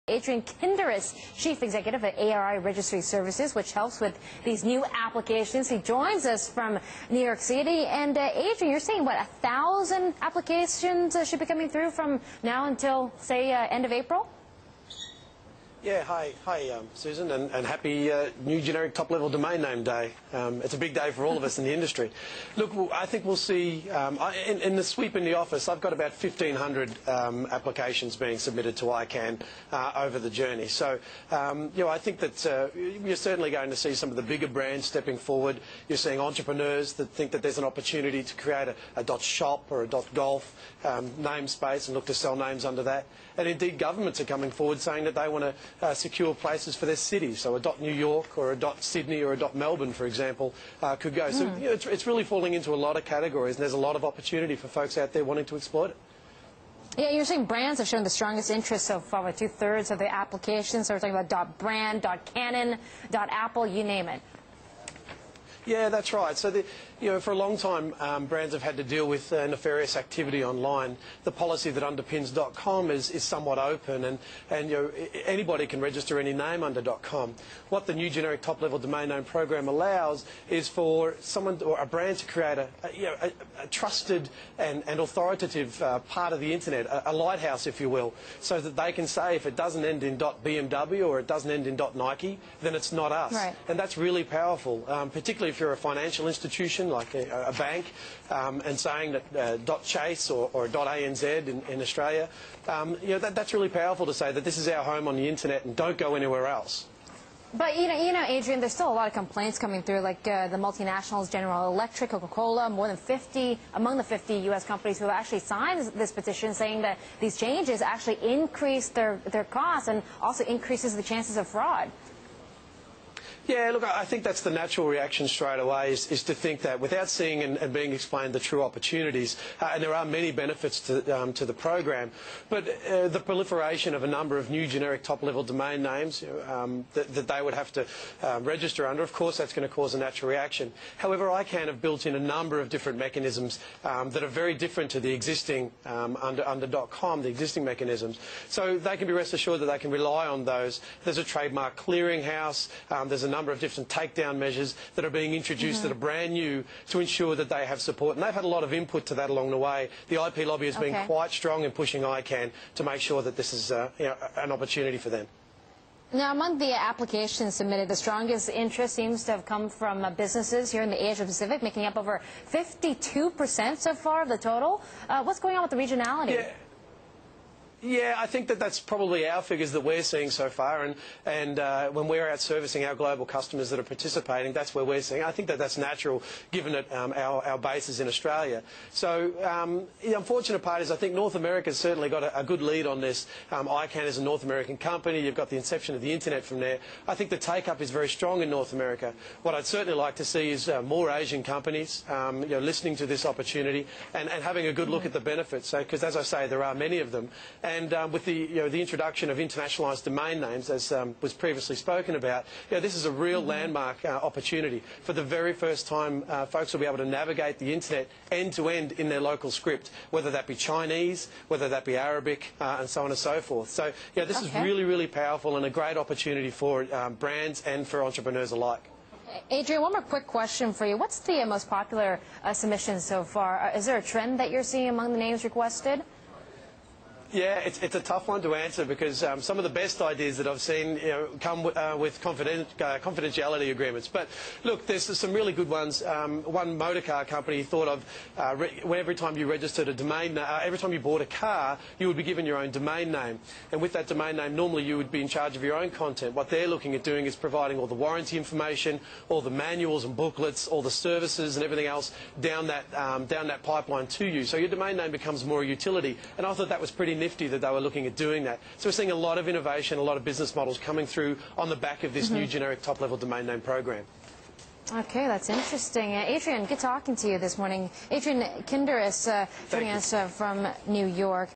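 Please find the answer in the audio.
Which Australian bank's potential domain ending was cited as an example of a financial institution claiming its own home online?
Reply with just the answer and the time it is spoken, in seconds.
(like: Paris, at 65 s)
ANZ, at 100 s.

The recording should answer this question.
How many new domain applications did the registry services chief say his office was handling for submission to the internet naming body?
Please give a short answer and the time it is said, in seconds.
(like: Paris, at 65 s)
1,500, at 26 s.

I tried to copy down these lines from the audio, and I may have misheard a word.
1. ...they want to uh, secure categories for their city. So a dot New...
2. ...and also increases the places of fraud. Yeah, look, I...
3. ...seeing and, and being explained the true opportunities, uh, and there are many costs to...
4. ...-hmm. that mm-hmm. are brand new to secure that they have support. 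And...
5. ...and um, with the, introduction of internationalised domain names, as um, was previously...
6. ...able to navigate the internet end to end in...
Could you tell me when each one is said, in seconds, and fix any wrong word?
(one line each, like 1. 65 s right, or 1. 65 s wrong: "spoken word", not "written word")
1. 45 s wrong: "places", not "categories"
2. 119 s wrong: "chances", not "places"
3. 127 s wrong: "benefits", not "costs"
4. 155 s wrong: "ensure", not "secure"
5. 207 s right
6. 216 s right.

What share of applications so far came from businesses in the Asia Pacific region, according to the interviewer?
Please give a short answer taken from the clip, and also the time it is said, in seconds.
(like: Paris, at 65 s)
52%, at 172 s.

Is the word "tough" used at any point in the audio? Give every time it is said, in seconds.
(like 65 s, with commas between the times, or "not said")
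238 s.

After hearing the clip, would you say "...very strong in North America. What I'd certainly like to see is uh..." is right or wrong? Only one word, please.
right.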